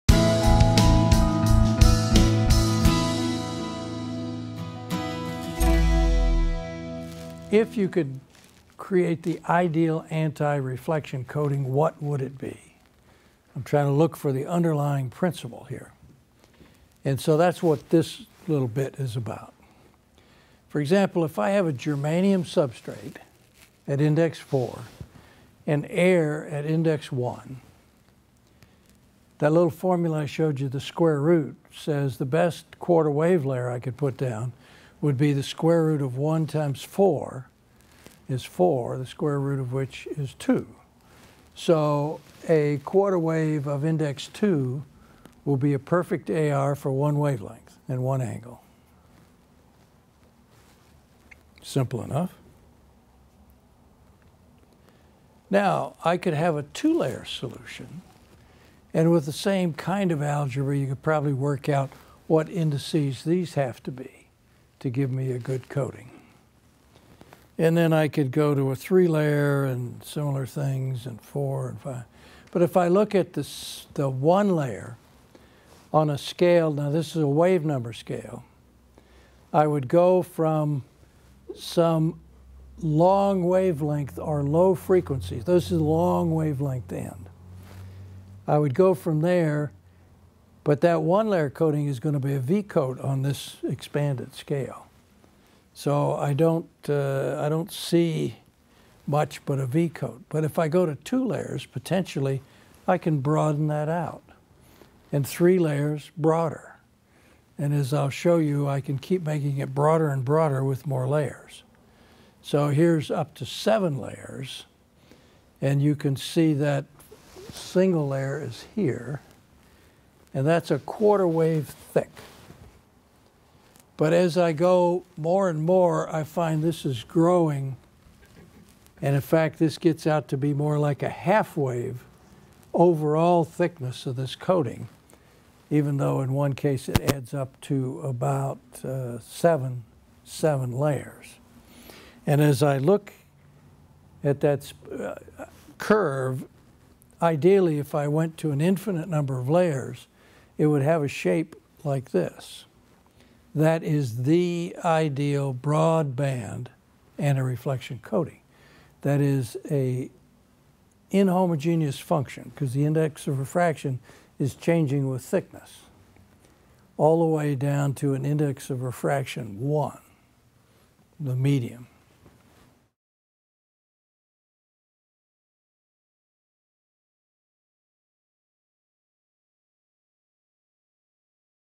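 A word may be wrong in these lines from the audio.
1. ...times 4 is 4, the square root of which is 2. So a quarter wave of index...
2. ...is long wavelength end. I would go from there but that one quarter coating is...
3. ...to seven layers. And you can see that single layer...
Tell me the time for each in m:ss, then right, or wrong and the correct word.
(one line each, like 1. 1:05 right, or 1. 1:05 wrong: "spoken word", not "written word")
1. 0:36 right
2. 1:25 wrong: "layer", not "quarter"
3. 1:53 right.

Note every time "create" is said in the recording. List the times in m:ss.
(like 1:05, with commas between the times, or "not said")
0:08.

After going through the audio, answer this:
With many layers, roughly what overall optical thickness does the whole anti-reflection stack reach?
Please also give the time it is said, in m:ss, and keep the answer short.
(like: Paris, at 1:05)
Half wave, at 2:11.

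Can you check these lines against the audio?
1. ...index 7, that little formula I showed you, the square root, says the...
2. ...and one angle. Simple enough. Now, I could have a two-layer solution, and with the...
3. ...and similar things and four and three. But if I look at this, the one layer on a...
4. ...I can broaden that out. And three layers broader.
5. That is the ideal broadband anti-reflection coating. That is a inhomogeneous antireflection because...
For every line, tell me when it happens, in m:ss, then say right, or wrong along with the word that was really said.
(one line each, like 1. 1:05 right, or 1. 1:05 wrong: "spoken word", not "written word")
1. 0:26 wrong: "1", not "7"
2. 0:47 right
3. 1:09 wrong: "five", not "three"
4. 1:42 right
5. 2:33 wrong: "function", not "antireflection".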